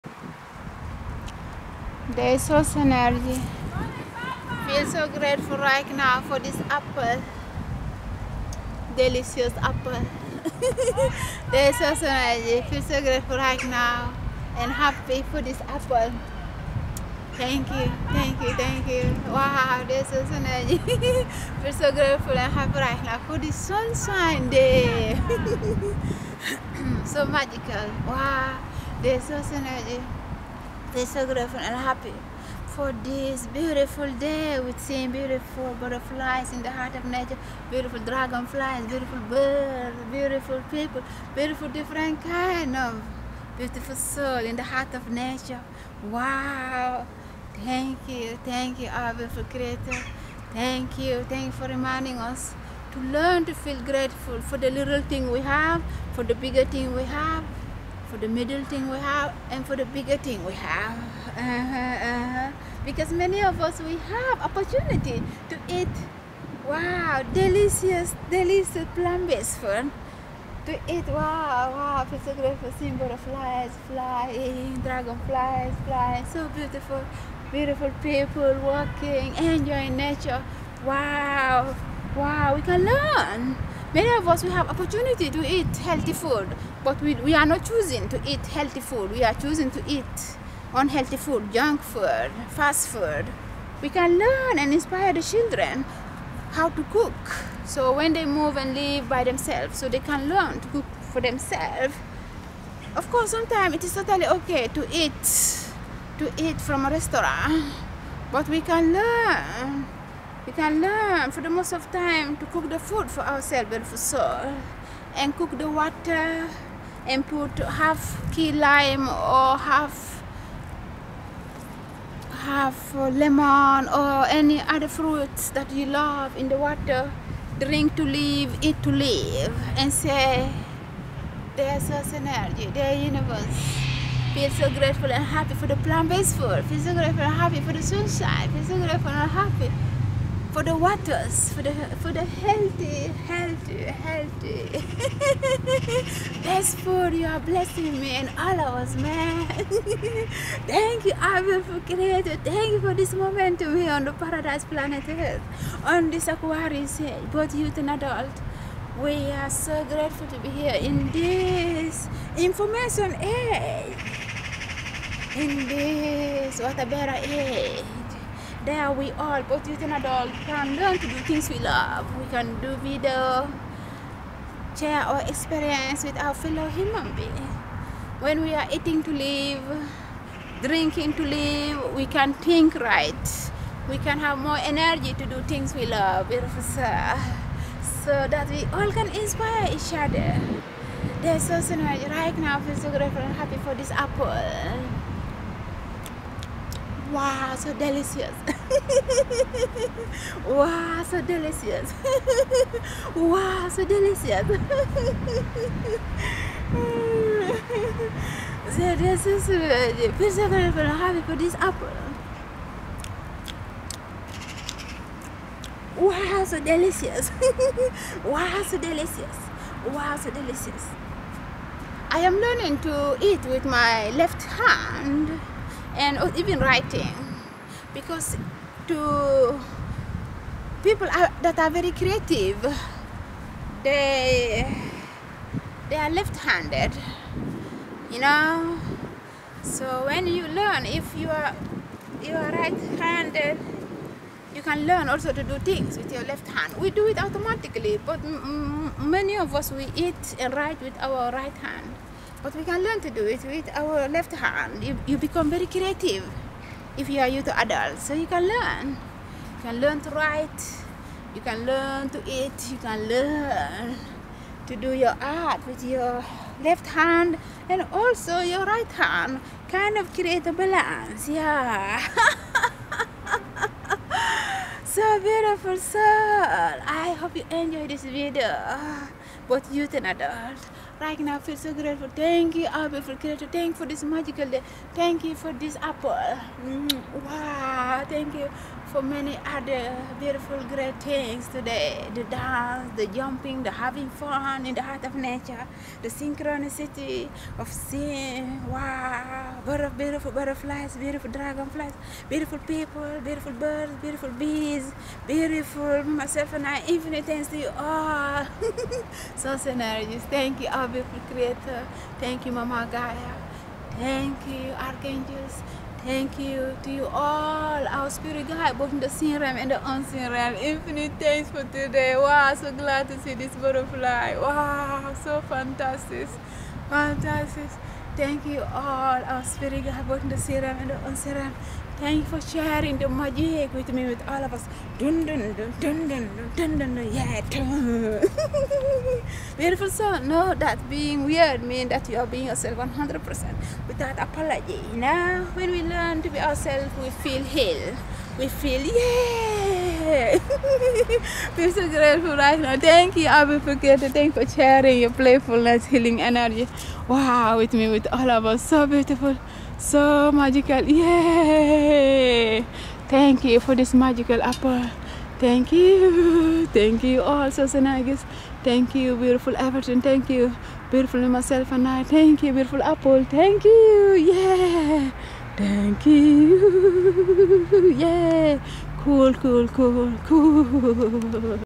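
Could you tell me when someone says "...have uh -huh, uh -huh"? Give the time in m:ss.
1:00.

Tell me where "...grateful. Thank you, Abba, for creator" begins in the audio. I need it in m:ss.
4:41.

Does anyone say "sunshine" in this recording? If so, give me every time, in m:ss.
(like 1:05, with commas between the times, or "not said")
0:23, 2:17.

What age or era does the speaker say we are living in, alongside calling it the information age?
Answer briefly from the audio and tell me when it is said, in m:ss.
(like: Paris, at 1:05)
water era, at 2:46.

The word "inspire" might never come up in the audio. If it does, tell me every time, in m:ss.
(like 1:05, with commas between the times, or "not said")
1:34, 3:09.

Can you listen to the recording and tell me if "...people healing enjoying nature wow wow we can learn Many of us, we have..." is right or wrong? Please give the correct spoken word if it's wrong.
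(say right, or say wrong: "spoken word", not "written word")
wrong: "walking", not "healing".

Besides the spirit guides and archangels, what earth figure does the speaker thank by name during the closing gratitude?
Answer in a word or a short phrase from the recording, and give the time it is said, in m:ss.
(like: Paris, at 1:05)
Mama Gaia, at 5:12.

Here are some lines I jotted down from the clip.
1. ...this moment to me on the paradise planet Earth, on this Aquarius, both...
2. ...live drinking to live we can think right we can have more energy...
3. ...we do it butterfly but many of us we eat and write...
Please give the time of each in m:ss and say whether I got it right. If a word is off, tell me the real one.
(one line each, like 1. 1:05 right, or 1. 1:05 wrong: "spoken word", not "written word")
1. 2:32 right
2. 2:59 right
3. 4:06 wrong: "automatically", not "butterfly".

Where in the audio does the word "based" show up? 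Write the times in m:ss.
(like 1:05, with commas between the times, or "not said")
1:08, 2:15.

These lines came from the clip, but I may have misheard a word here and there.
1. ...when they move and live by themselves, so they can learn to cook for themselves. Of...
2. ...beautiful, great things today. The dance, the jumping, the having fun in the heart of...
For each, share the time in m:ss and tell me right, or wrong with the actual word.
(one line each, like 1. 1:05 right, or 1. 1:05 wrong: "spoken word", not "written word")
1. 1:37 right
2. 4:50 right.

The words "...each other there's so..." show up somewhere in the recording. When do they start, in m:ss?
3:09.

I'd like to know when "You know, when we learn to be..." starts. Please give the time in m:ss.
5:44.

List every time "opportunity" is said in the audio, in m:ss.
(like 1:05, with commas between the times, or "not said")
1:04, 1:24.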